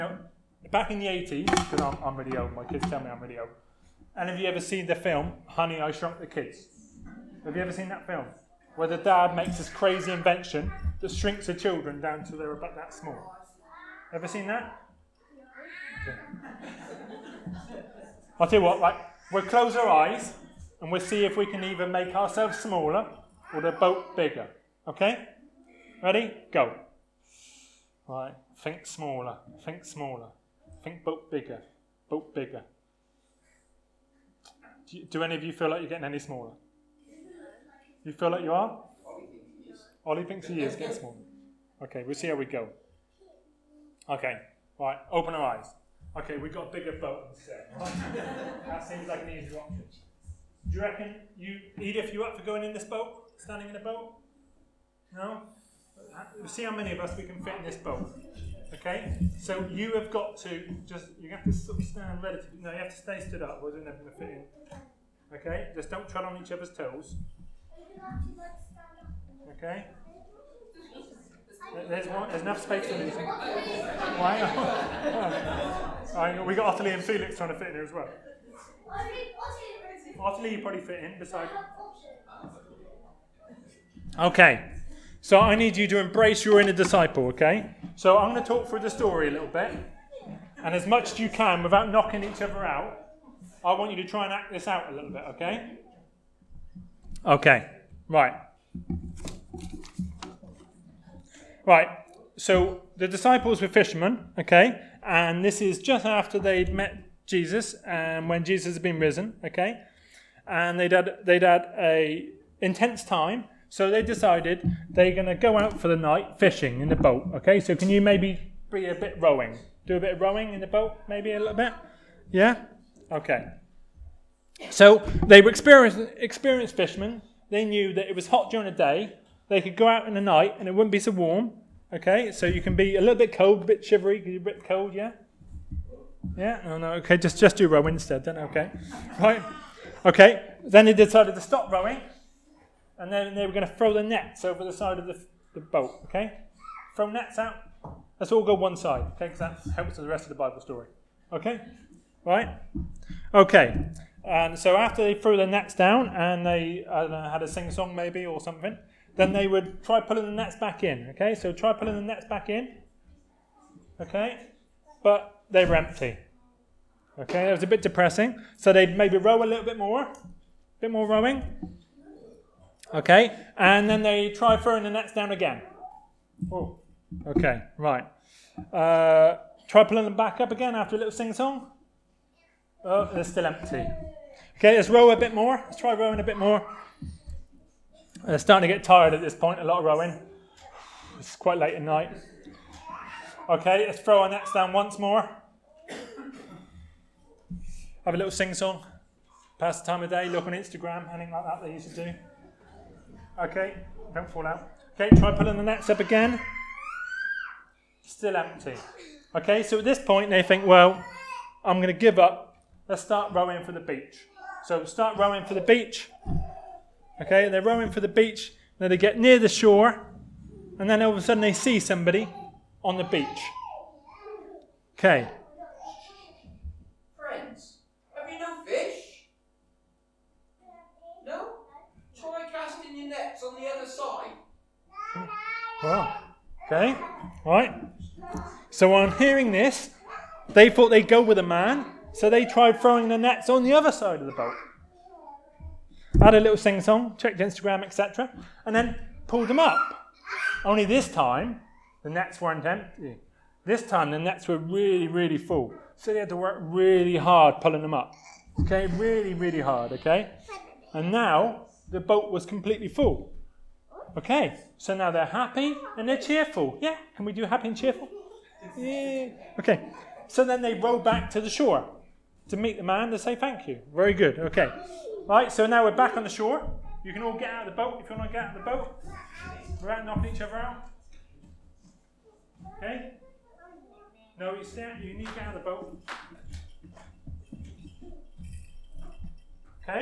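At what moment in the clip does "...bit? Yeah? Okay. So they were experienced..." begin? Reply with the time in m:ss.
2:01.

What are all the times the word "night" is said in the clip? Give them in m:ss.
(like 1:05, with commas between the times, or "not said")
1:55, 2:10, 3:11.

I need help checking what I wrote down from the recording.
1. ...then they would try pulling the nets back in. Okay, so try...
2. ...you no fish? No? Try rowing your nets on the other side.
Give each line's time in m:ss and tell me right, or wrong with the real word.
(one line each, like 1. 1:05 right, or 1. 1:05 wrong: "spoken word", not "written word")
1. 2:39 right
2. 3:48 wrong: "casting", not "rowing".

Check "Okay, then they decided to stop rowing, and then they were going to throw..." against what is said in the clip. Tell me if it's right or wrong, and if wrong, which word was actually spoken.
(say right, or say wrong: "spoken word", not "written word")
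right.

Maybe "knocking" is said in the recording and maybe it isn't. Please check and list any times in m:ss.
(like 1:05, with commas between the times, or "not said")
1:31, 4:40.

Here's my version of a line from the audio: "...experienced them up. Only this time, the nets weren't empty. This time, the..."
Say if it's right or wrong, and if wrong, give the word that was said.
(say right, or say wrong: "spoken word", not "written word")
wrong: "pulled", not "experienced".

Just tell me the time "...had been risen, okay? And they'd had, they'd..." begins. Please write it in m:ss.
1:48.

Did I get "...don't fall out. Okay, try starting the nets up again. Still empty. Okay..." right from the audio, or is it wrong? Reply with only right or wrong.
wrong.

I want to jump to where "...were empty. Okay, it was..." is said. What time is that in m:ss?
2:45.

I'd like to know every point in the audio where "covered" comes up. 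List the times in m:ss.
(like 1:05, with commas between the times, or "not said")
not said.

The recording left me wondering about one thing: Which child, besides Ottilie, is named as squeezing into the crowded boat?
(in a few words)
Felix.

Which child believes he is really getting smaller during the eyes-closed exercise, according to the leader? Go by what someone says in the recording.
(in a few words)
Ollie.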